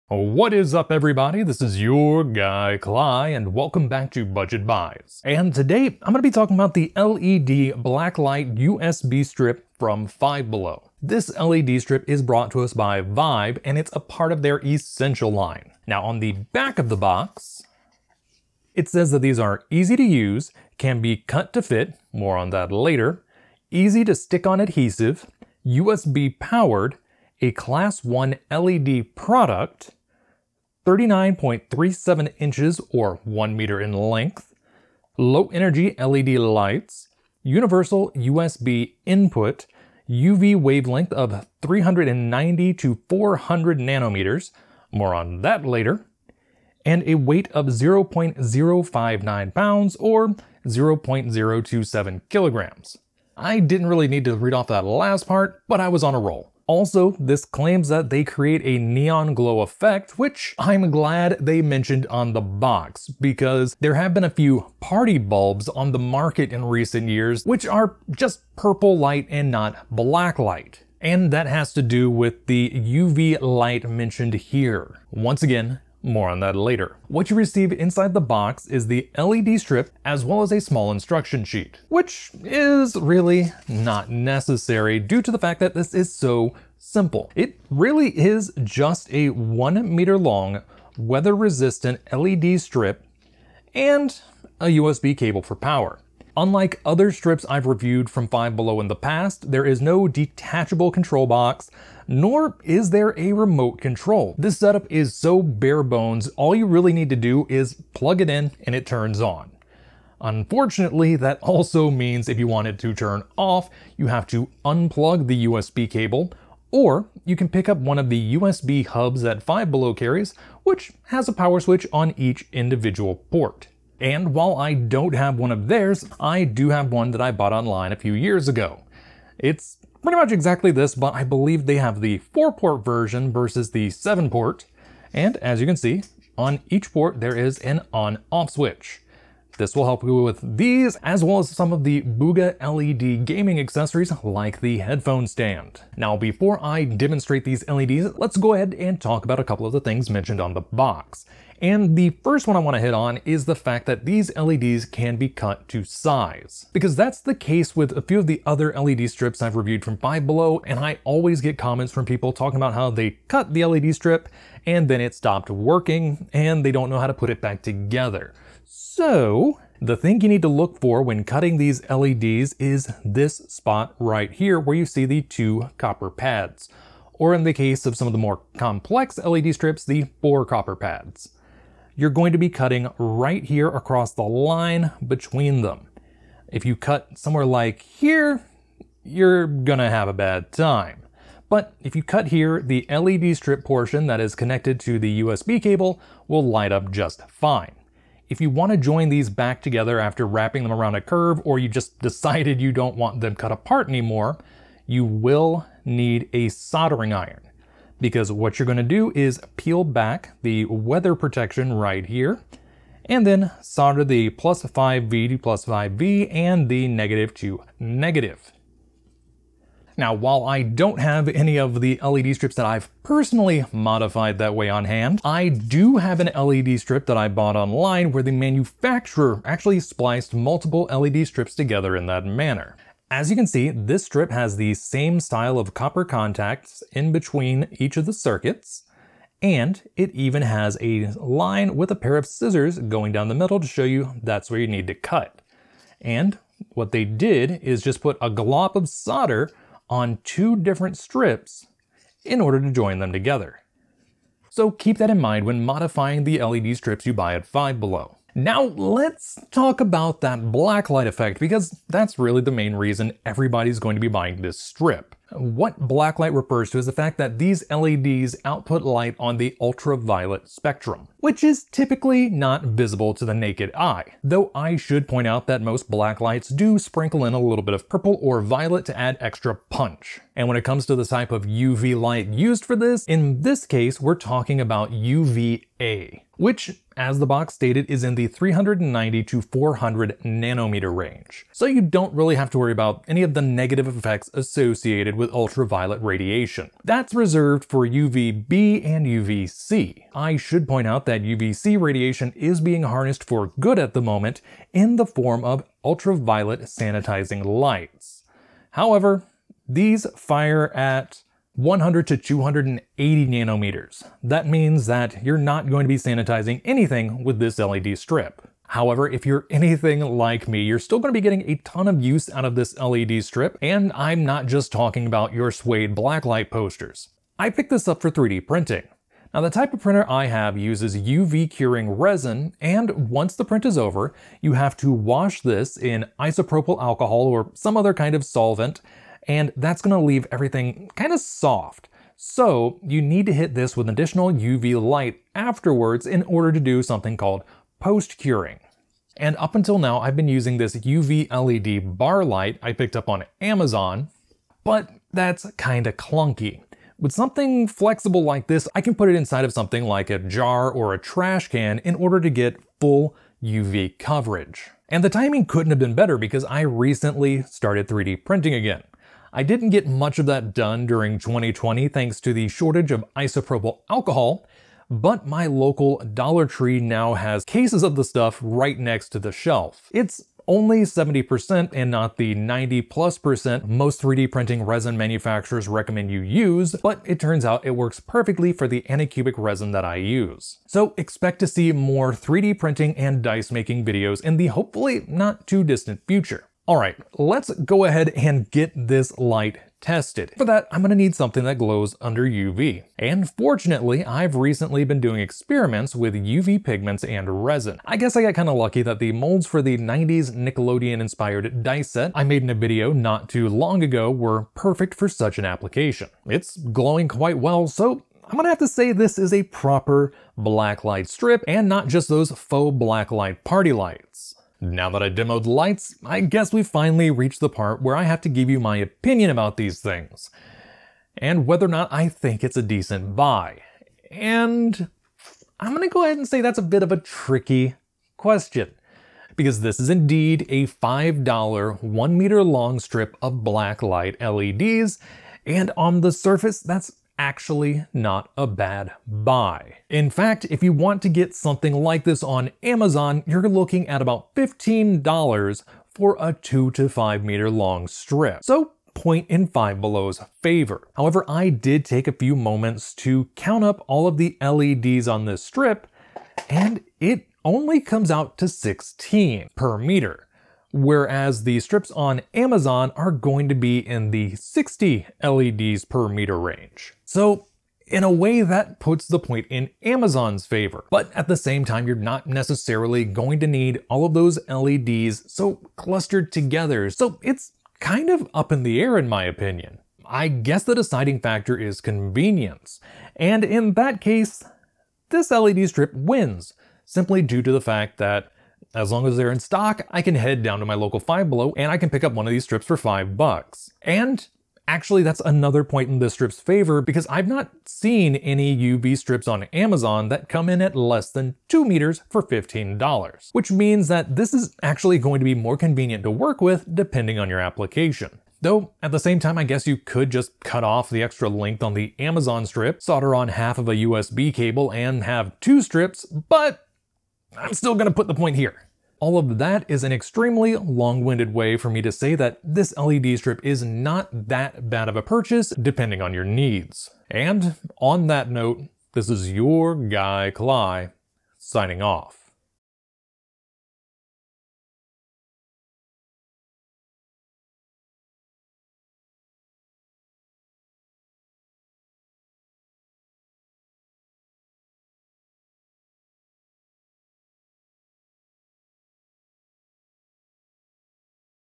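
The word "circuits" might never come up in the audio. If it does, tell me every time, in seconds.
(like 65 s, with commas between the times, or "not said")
238 s.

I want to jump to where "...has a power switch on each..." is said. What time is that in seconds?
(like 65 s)
121 s.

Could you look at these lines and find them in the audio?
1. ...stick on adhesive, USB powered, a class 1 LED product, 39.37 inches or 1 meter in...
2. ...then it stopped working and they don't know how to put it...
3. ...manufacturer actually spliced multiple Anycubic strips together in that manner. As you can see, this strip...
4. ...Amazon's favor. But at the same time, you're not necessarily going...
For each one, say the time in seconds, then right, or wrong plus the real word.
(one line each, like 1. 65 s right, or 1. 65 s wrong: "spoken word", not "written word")
1. 24 s right
2. 164 s right
3. 228 s wrong: "LED", not "Anycubic"
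4. 479 s right.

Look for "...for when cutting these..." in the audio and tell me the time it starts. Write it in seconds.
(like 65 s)
170 s.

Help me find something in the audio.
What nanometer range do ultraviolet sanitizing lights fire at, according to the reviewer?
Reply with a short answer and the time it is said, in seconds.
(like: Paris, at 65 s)
100 to 280 nanometers, at 311 s.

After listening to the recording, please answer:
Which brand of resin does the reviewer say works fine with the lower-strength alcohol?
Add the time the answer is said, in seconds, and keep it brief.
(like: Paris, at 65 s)
Anycubic, at 388 s.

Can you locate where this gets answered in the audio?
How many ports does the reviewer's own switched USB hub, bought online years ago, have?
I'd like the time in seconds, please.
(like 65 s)
133 s.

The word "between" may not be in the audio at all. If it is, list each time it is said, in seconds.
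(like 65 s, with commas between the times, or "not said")
185 s, 237 s.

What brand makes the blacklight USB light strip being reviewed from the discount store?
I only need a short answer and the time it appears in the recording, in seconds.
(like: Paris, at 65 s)
Vibe, at 13 s.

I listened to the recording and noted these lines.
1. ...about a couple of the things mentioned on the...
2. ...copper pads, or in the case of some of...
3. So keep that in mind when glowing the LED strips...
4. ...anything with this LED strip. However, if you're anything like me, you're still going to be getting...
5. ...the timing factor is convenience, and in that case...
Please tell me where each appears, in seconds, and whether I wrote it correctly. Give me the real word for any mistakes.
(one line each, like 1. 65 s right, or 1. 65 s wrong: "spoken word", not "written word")
1. 149 s right
2. 175 s right
3. 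254 s wrong: "modifying", not "glowing"
4. 316 s right
5. 490 s wrong: "deciding", not "timing".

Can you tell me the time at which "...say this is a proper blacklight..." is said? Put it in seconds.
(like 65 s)
418 s.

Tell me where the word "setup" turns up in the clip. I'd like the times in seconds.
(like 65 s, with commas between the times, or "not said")
104 s.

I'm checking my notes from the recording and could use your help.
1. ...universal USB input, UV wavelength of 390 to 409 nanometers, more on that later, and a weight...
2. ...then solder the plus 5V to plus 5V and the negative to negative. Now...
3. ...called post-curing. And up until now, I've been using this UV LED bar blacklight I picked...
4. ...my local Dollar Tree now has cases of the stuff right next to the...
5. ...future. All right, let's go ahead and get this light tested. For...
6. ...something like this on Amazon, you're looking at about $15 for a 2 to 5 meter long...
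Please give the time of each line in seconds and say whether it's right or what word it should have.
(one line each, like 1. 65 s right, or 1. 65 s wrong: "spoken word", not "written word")
1. 37 s wrong: "400", not "409"
2. 213 s right
3. 347 s wrong: "light", not "blacklight"
4. 375 s right
5. 396 s right
6. 451 s right.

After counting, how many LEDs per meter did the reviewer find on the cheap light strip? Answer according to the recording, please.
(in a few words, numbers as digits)
16.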